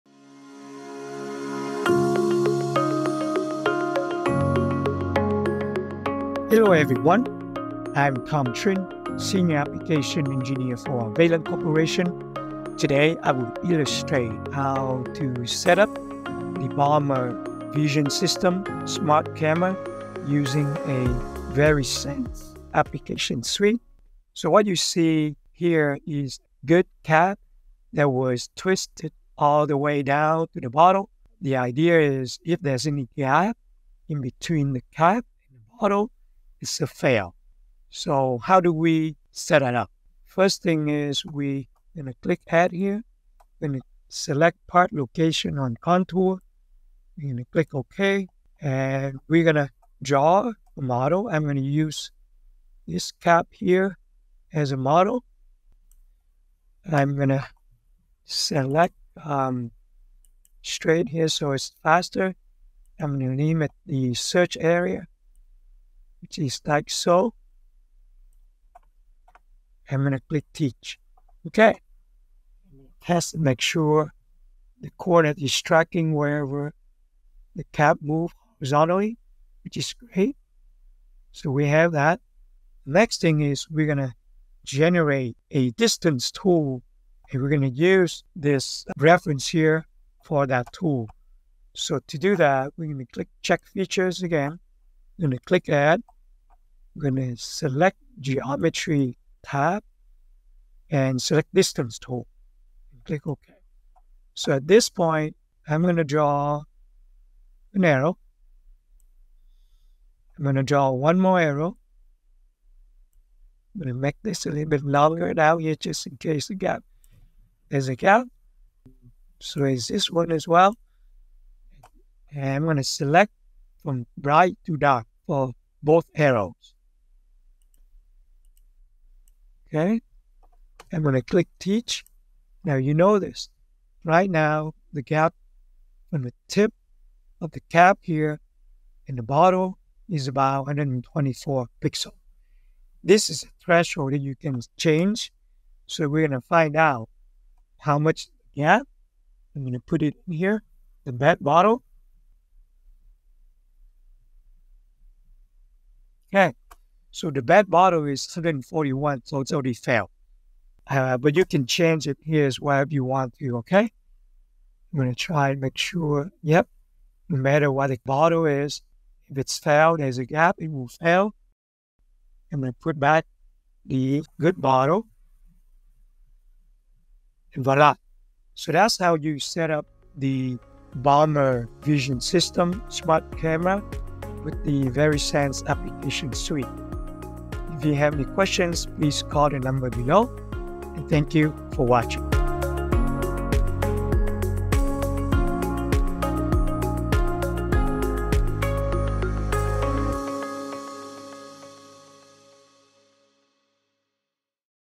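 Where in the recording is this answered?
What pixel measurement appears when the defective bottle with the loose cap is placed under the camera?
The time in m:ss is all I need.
2:38.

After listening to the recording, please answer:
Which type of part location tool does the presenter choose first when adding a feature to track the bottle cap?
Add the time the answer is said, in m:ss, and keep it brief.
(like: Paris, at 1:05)
on contour, at 0:45.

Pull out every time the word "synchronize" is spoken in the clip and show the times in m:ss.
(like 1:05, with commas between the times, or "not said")
not said.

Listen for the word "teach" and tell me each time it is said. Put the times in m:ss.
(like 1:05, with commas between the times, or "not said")
1:10, 2:11.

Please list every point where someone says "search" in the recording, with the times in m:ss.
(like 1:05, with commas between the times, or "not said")
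1:04.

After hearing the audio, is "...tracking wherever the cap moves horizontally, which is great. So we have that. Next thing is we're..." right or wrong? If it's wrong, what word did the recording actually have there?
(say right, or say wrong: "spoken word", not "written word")
right.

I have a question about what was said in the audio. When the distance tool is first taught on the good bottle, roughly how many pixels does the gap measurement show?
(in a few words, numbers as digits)
124.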